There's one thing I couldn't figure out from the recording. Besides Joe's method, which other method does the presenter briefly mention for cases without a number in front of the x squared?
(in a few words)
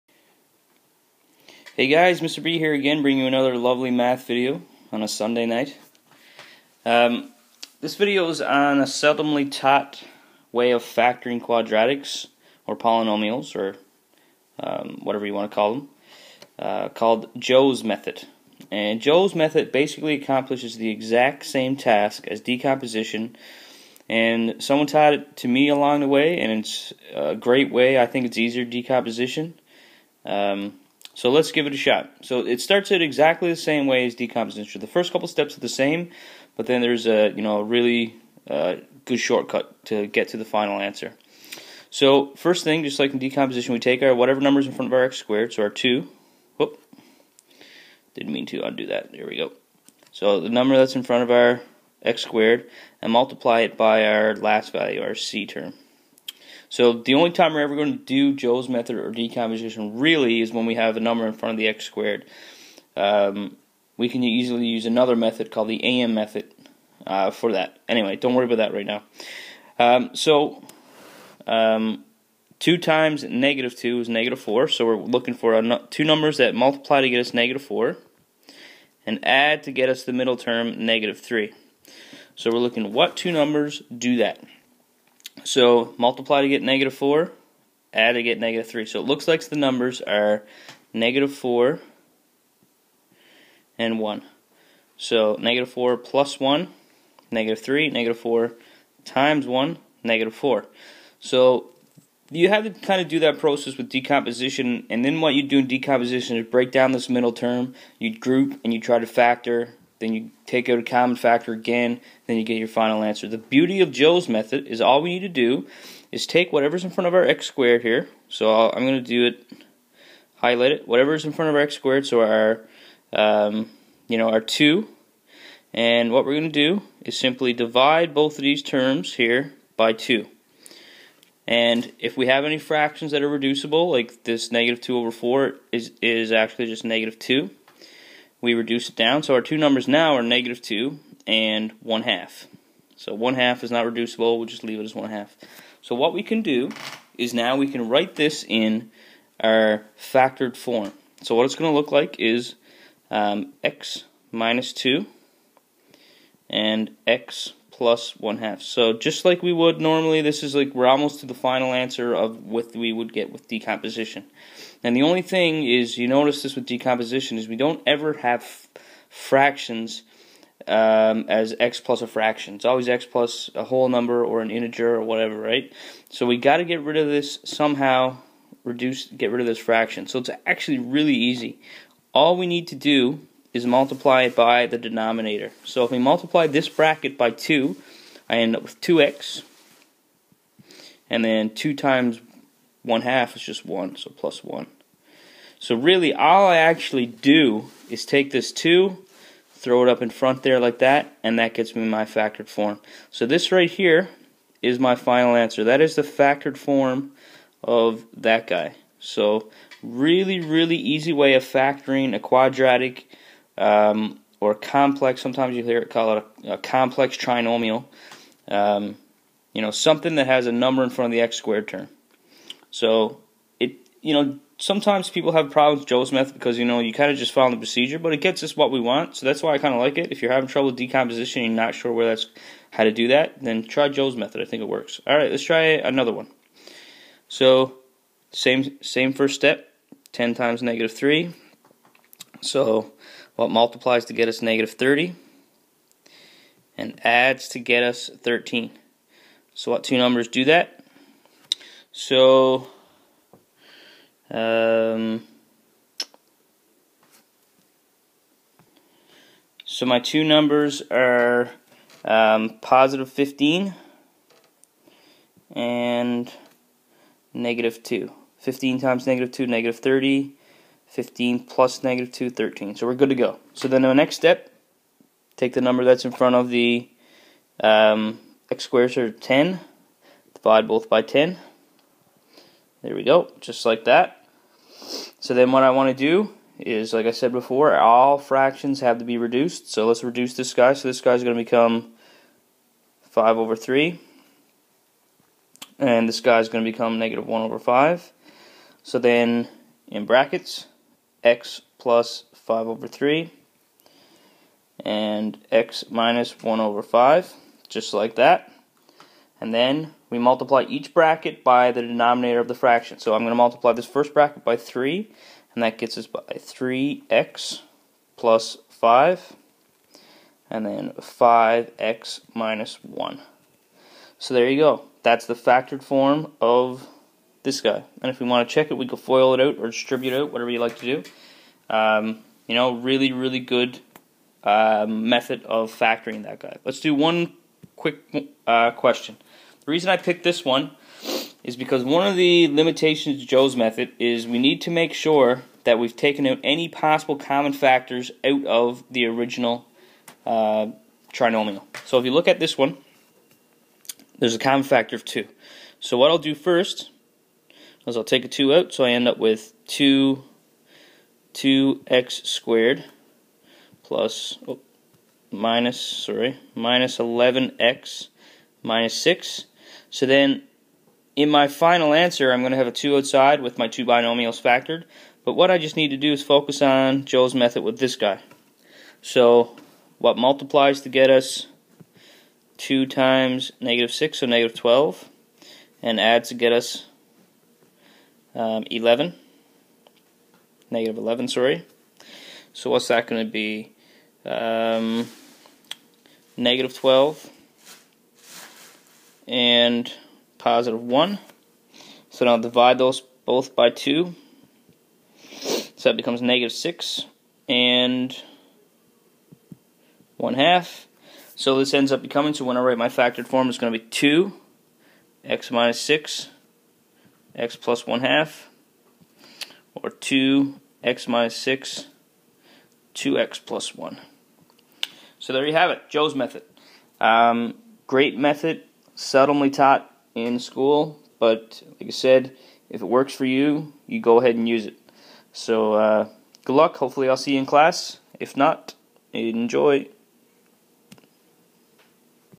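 AM method.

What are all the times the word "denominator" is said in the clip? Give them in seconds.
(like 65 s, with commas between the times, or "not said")
184 s, 311 s.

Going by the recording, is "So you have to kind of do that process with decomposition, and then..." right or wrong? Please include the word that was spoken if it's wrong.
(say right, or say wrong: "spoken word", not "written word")
right.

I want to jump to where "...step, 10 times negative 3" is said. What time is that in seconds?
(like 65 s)
239 s.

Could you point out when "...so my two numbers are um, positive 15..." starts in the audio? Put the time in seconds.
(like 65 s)
259 s.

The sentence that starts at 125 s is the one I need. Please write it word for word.
And what we're going to do is simply divide both of these terms here by 2.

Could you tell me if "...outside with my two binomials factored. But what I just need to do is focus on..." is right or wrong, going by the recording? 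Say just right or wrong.
right.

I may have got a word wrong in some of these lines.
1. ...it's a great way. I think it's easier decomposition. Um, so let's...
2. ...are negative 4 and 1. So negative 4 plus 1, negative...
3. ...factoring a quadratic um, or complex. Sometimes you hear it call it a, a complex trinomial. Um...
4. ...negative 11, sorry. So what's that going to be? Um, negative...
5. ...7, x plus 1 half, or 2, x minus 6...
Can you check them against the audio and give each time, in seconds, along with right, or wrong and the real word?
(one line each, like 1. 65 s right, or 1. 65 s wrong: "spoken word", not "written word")
1. 26 s right
2. 90 s right
3. 211 s right
4. 390 s right
5. 415 s wrong: "6", not "7".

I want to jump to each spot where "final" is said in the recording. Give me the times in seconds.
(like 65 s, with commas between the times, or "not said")
40 s, 112 s, 161 s, 204 s, 371 s.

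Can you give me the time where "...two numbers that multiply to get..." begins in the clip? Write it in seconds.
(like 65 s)
75 s.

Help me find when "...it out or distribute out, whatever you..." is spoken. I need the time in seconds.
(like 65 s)
329 s.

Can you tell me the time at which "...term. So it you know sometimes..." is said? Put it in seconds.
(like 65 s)
221 s.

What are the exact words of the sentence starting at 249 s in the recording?
So what two numbers do that?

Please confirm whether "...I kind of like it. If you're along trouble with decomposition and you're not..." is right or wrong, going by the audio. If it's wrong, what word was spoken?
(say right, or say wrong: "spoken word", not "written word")
wrong: "having", not "along".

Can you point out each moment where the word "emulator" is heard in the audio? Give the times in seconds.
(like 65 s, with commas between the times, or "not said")
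not said.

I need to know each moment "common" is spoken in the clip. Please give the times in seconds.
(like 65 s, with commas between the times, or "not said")
110 s, 347 s, 354 s.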